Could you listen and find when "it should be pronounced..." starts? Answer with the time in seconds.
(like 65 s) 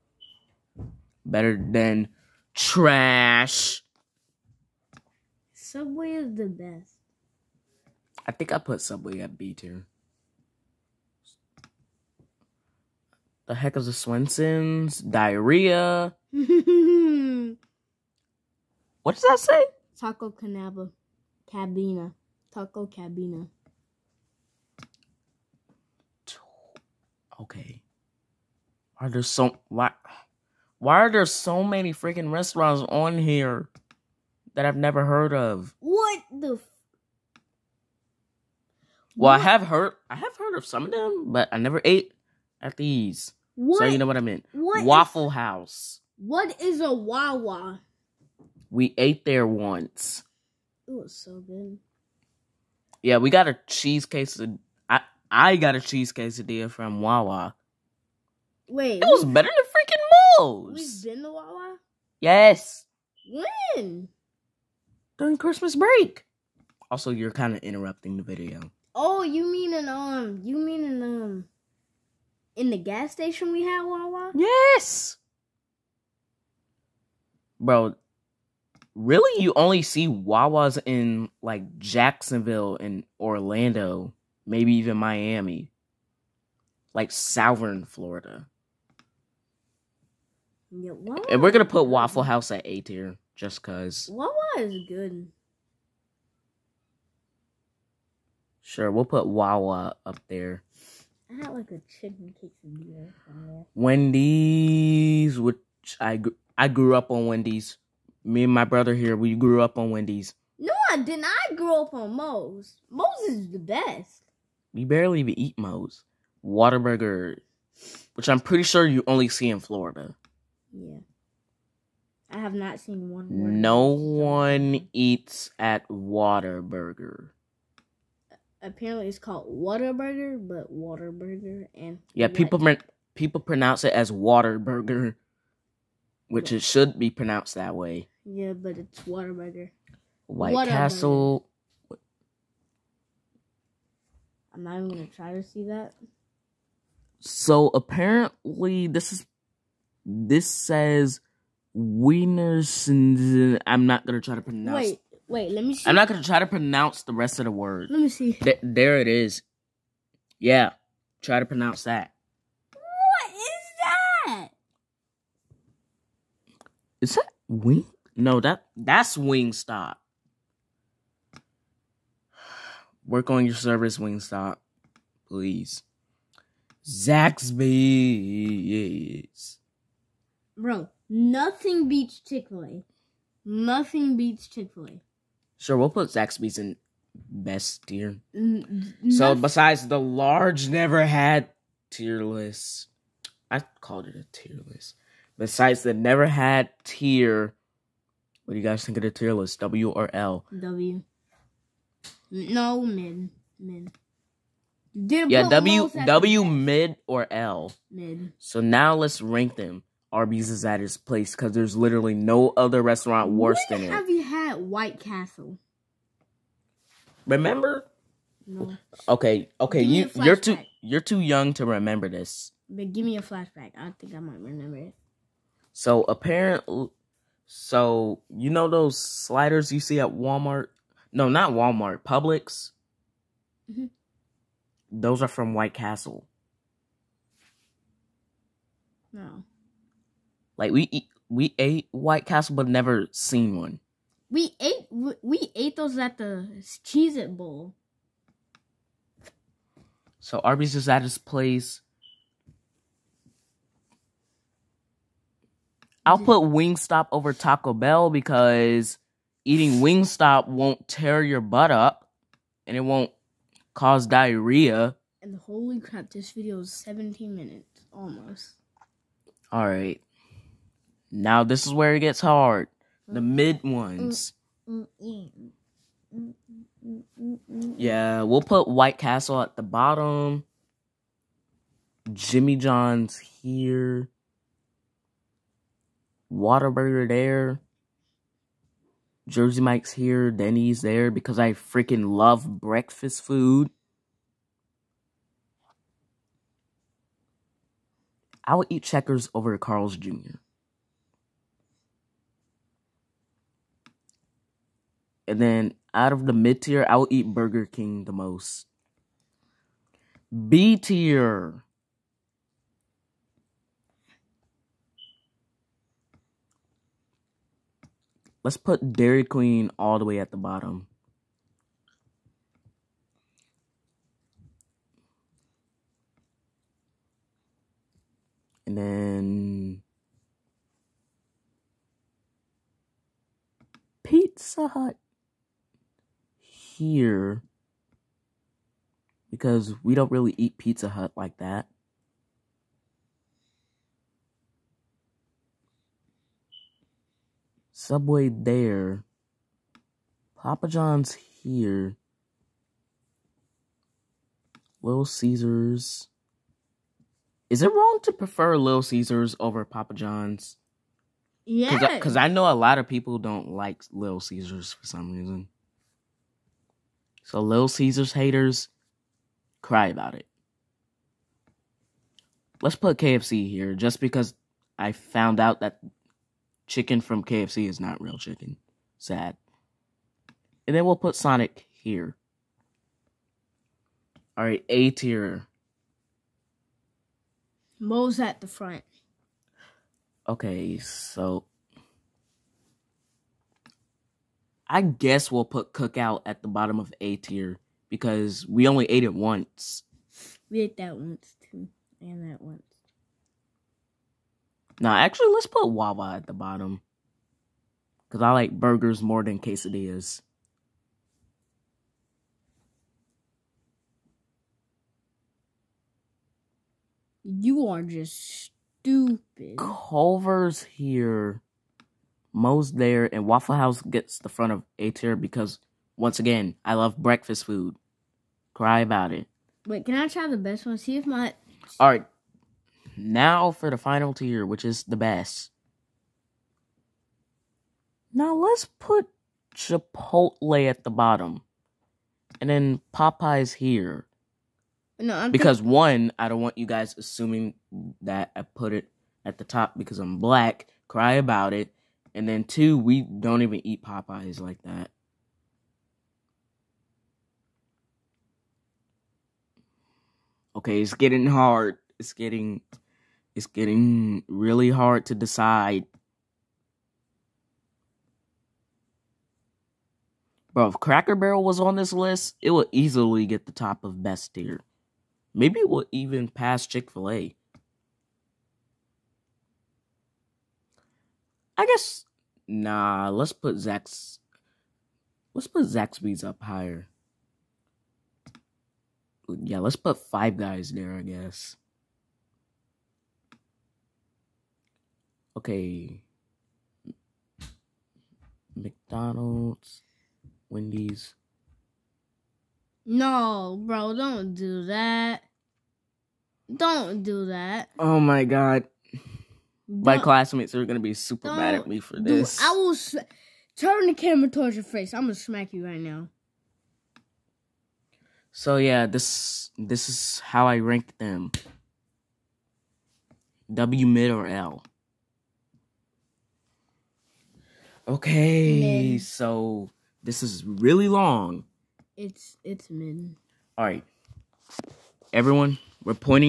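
136 s.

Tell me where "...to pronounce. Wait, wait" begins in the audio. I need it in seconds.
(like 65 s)
154 s.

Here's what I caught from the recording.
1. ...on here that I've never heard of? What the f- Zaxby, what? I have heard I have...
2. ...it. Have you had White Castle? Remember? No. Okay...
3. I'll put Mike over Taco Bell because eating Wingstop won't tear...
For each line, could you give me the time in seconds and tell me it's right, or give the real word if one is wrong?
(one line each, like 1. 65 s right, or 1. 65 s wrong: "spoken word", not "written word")
1. 32 s wrong: "Well", not "Zaxby"
2. 213 s right
3. 256 s wrong: "Wingstop", not "Mike".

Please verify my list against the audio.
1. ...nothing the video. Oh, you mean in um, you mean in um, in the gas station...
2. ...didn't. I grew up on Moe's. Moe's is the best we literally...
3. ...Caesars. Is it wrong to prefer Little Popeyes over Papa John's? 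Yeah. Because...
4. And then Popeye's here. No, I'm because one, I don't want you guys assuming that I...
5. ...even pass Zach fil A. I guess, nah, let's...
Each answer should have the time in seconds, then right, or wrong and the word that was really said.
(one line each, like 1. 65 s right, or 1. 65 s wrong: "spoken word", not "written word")
1. 67 s wrong: "interrupting", not "nothing"
2. 110 s wrong: "barely", not "literally"
3. 355 s wrong: "Caesars", not "Popeyes"
4. 442 s right
5. 475 s wrong: "Chick", not "Zach".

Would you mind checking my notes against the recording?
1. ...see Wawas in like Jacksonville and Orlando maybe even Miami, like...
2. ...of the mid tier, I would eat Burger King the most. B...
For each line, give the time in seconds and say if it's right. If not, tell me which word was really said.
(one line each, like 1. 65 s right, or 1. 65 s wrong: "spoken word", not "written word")
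1. 79 s right
2. 306 s right.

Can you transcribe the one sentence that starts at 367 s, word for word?
So, Little Caesars haters, cry about it.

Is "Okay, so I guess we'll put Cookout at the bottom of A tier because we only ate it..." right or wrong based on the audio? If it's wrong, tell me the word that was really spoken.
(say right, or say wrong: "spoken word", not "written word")
right.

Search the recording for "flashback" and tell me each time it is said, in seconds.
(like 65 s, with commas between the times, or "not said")
223 s.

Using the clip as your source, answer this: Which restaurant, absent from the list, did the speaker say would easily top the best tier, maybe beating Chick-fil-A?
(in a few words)
Cracker Barrel.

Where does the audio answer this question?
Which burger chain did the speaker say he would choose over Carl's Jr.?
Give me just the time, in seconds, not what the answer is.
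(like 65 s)
298 s.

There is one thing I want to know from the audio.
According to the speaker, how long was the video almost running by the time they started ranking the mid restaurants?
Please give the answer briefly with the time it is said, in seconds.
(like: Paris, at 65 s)
17 minutes, at 266 s.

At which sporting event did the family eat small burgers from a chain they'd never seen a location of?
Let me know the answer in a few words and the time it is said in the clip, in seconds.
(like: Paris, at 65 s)
Cheez It Bowl, at 246 s.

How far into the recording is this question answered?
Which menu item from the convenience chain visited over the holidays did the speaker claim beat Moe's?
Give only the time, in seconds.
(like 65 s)
55 s.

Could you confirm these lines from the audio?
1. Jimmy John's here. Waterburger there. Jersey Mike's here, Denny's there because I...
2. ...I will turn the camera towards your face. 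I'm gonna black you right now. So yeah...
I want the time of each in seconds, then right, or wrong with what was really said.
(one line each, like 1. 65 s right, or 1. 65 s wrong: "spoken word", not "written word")
1. 282 s right
2. 512 s wrong: "smack", not "black".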